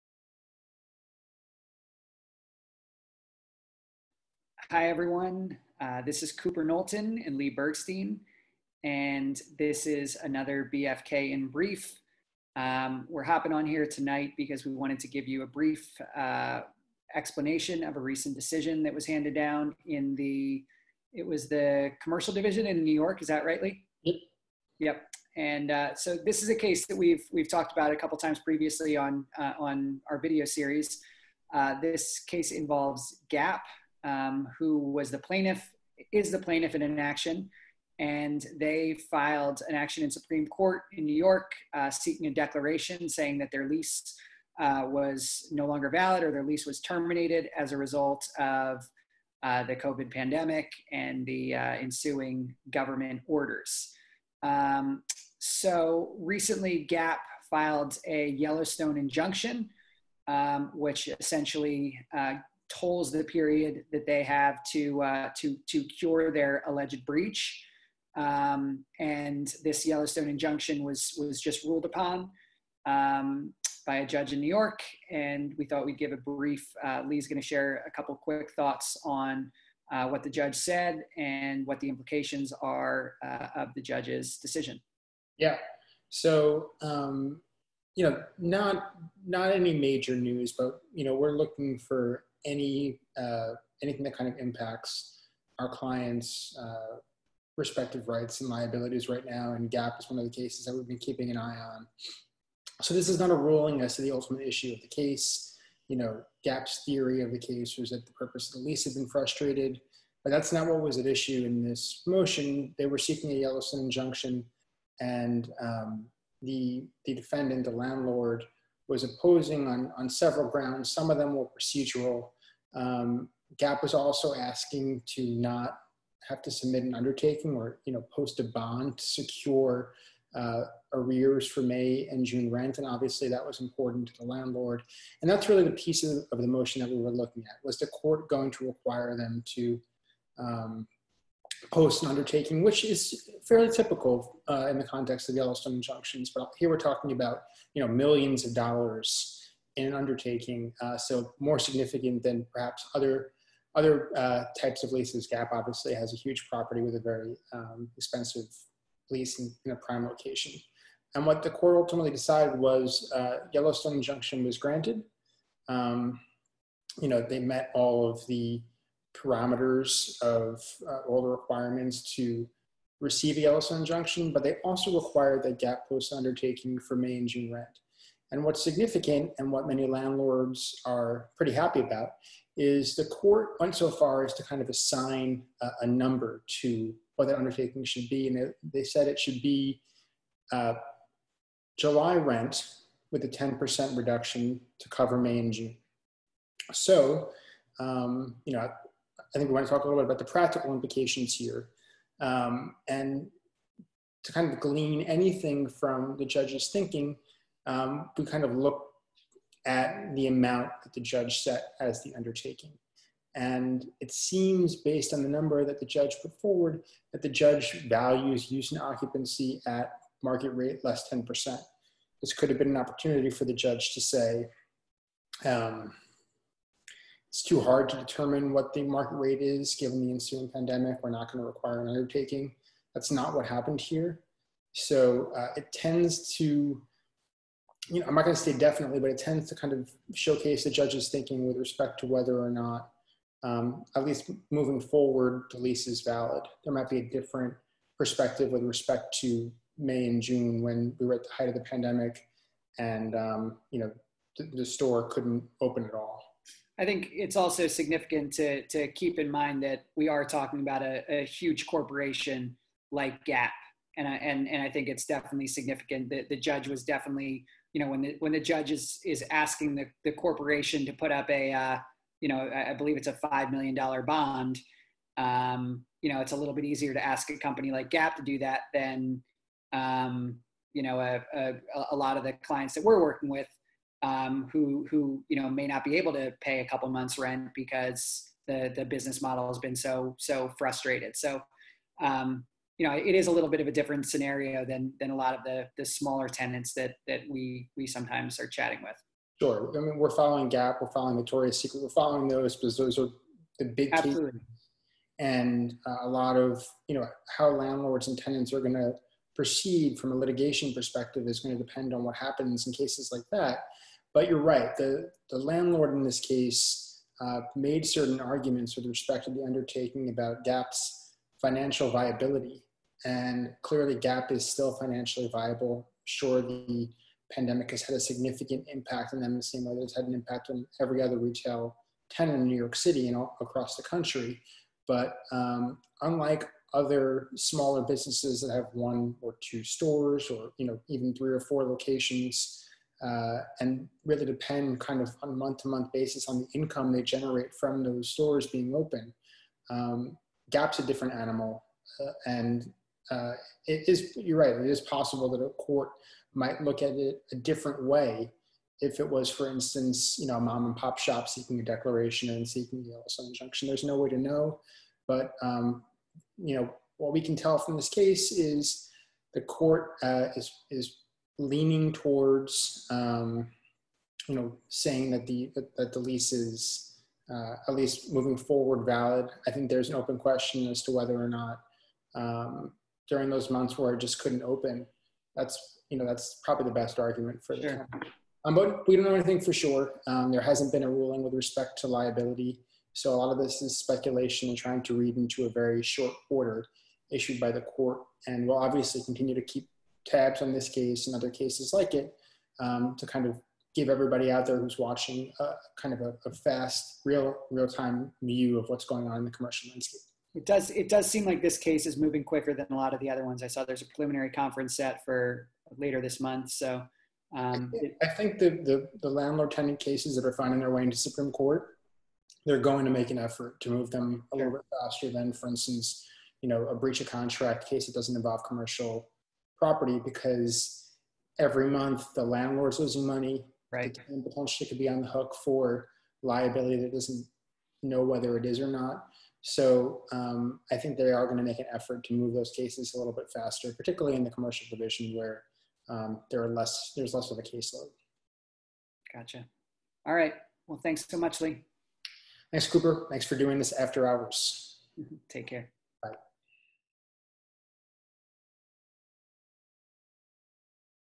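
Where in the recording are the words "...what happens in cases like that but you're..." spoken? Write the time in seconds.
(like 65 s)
312 s.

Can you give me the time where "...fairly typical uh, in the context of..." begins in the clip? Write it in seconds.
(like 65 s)
143 s.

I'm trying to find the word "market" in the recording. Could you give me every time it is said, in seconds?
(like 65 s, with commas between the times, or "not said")
220 s, 228 s.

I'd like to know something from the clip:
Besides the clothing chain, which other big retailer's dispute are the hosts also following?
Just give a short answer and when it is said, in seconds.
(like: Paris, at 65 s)
Victoria's Secret, at 301 s.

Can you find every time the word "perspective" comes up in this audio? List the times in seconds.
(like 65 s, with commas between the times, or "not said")
247 s, 310 s.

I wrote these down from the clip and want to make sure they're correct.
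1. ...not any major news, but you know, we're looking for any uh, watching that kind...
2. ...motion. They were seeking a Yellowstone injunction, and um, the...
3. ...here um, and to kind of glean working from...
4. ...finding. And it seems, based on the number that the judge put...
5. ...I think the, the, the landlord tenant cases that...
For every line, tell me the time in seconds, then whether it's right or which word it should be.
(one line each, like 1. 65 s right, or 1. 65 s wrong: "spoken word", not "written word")
1. 89 s wrong: "anything", not "watching"
2. 112 s right
3. 201 s wrong: "anything", not "working"
4. 212 s wrong: "undertaking", not "finding"
5. 418 s right.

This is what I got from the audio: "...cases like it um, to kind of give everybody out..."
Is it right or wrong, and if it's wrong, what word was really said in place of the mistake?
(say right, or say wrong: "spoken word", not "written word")
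right.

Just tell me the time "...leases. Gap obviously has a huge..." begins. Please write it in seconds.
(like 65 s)
154 s.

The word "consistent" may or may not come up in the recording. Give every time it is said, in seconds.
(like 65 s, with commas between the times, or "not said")
not said.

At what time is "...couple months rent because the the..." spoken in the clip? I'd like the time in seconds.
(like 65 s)
286 s.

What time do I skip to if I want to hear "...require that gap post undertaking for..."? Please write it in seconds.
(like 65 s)
174 s.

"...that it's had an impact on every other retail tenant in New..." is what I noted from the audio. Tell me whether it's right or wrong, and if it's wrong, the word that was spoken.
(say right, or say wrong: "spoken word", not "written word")
right.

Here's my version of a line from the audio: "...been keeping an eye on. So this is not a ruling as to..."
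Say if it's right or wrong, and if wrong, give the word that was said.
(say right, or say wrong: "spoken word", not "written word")
right.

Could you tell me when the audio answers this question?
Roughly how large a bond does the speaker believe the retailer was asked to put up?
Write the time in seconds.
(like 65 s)
273 s.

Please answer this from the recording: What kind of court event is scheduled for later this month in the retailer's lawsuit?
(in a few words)
Preliminary conference.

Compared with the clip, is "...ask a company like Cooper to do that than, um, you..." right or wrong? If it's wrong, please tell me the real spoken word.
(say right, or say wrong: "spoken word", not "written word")
wrong: "Gap", not "Cooper".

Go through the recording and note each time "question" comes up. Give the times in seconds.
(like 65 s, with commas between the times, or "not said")
380 s.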